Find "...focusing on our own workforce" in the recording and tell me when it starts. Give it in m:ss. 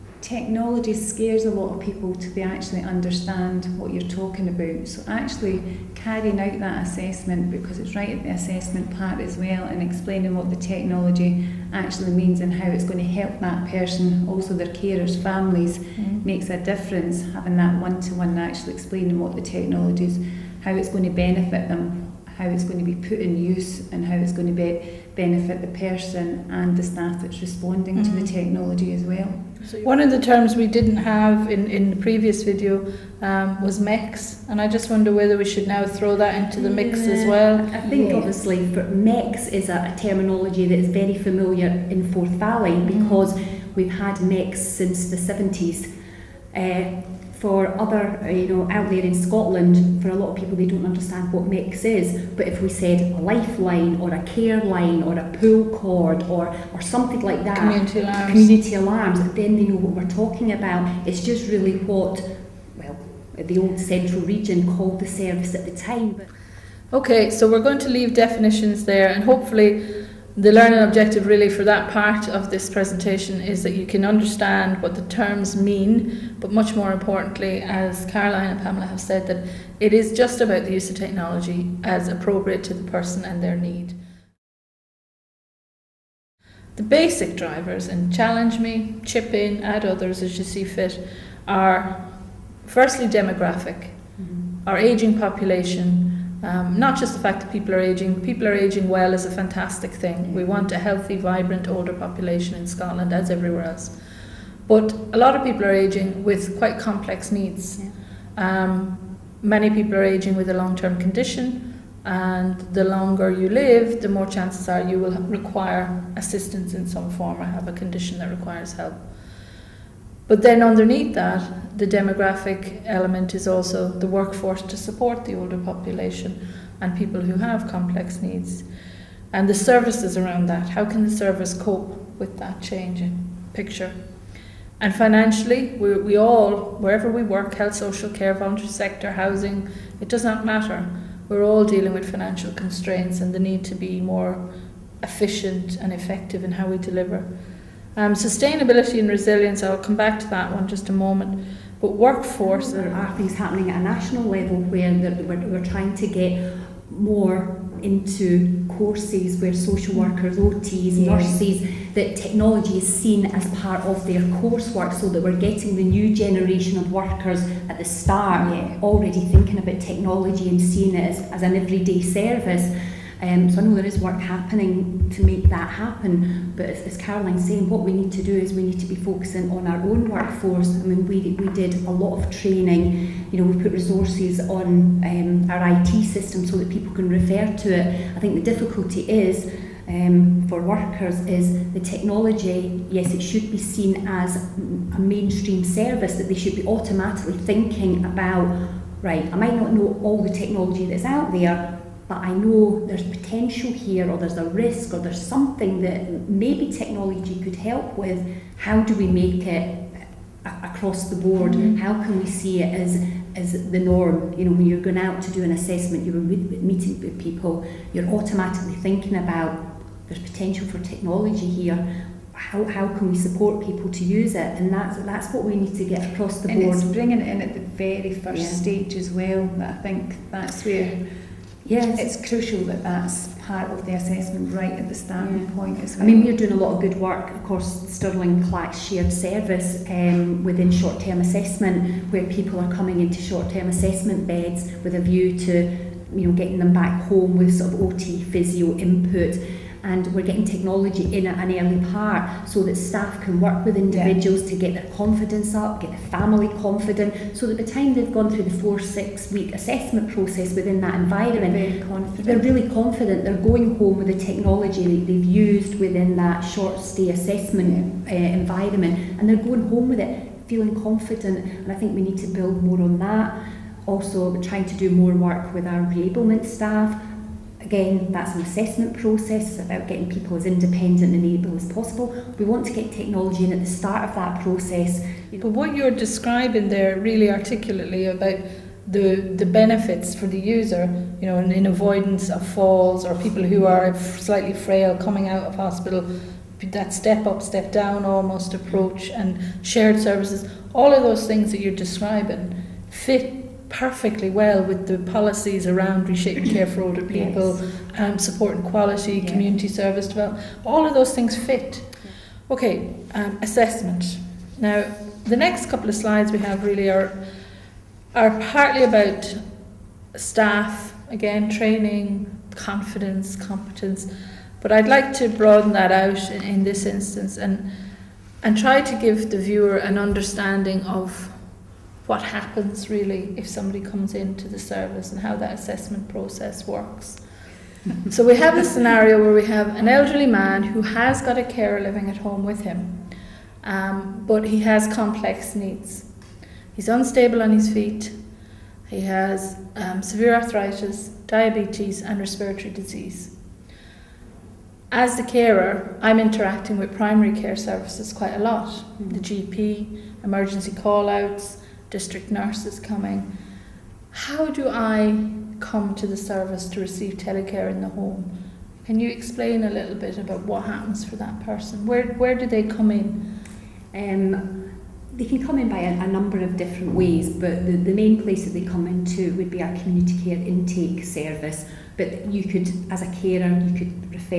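2:58.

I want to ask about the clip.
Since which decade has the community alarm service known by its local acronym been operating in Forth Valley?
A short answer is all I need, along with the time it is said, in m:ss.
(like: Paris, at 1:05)
1970s, at 0:45.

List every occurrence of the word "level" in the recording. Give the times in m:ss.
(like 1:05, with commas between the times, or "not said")
2:34.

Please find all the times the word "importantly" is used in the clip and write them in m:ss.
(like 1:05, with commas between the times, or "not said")
1:16.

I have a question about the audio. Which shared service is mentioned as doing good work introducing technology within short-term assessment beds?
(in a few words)
Stirling Clack Shared Service.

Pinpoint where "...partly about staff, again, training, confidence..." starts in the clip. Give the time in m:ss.
5:18.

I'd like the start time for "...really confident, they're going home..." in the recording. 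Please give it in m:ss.
4:22.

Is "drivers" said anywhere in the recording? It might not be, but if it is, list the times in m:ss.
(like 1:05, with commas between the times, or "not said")
1:27.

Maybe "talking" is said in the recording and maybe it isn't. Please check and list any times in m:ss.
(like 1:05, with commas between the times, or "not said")
0:04, 1:00.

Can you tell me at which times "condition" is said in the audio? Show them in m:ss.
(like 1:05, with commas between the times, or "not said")
1:50, 1:57.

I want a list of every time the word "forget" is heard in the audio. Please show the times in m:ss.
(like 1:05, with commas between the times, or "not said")
not said.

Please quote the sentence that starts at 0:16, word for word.
makes a difference having that one-to-one -one, actually explaining what the technology is, how it's going to benefit them.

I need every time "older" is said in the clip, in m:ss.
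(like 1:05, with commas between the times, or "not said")
1:41, 2:05, 5:06.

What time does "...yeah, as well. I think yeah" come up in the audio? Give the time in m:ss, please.
0:36.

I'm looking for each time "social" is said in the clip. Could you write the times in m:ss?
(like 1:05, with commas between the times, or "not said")
2:17, 2:39.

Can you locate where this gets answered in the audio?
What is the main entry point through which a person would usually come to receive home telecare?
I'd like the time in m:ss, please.
6:19.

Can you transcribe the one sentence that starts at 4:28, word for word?
uh, environment and they're going home with it feeling confident and I think we need to build more on that.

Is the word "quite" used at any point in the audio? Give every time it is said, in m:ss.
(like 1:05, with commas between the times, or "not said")
1:46, 5:58.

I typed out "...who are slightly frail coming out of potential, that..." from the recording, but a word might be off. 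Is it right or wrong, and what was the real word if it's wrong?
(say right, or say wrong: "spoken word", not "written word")
wrong: "hospital", not "potential".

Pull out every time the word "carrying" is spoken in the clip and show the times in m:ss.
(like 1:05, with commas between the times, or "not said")
0:05.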